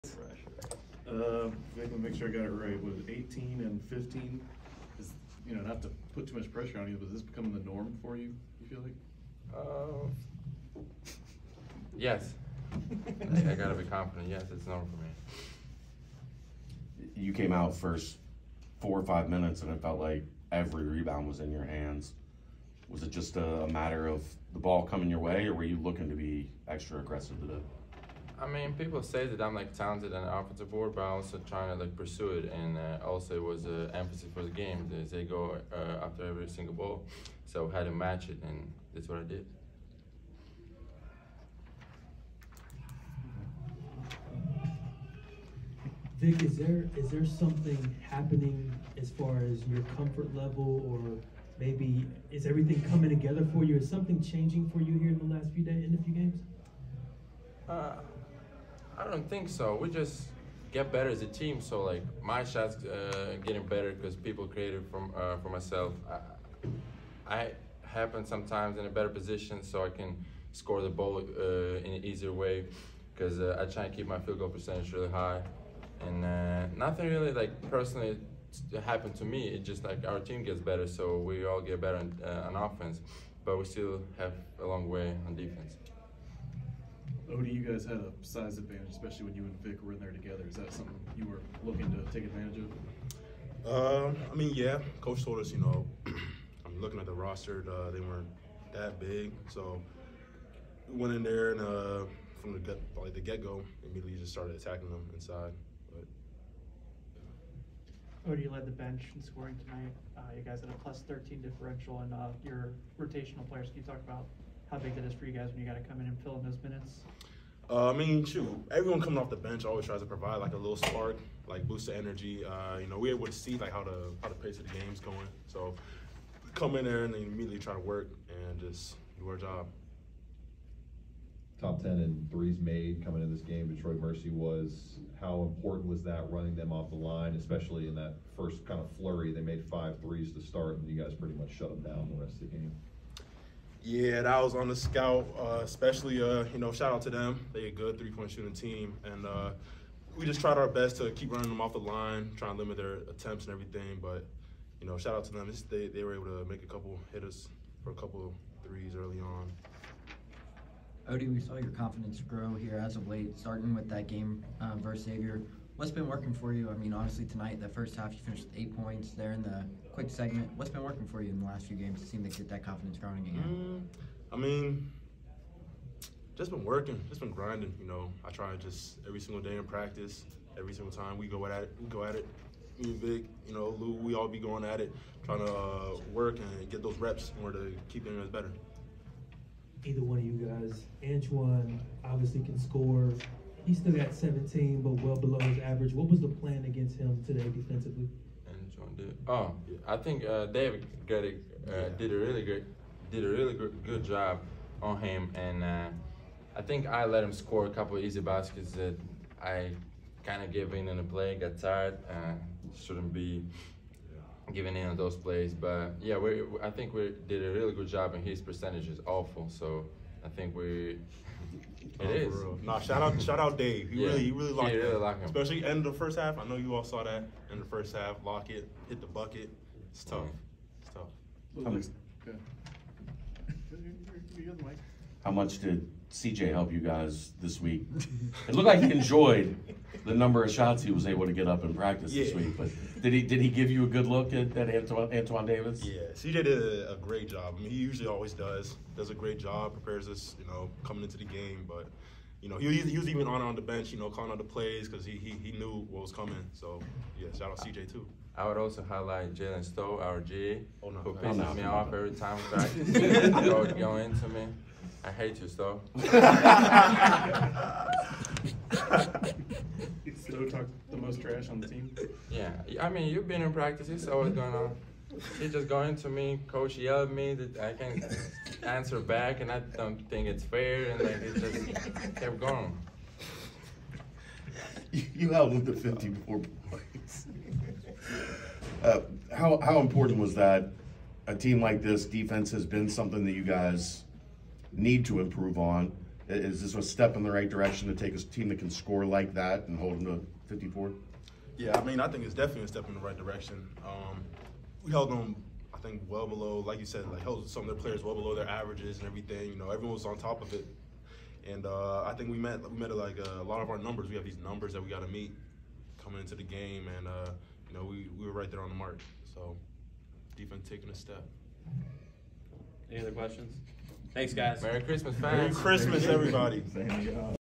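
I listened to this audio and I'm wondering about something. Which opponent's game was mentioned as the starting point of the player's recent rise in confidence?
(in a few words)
Xavier.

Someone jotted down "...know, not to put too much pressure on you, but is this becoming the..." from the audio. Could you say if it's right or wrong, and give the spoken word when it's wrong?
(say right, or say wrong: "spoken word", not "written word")
right.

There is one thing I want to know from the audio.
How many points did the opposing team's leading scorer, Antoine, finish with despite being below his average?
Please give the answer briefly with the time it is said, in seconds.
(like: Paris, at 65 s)
17, at 194 s.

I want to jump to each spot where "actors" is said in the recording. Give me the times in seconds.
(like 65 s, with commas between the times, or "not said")
not said.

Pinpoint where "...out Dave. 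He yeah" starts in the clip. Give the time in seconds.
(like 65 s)
223 s.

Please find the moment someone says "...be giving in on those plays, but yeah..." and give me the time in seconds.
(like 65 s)
213 s.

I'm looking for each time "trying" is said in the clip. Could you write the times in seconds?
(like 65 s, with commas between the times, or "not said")
31 s, 152 s, 185 s.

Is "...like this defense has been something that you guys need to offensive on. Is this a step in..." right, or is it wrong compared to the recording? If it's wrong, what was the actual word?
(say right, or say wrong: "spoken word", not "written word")
wrong: "improve", not "offensive".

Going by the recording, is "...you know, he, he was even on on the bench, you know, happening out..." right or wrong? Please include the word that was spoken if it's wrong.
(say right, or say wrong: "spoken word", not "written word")
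wrong: "calling", not "happening".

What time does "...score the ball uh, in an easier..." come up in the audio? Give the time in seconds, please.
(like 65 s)
70 s.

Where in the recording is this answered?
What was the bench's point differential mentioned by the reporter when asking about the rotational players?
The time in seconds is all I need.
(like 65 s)
110 s.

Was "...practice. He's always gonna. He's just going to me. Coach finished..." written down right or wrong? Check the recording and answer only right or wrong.
wrong.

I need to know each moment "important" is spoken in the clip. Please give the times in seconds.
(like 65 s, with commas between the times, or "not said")
135 s, 289 s.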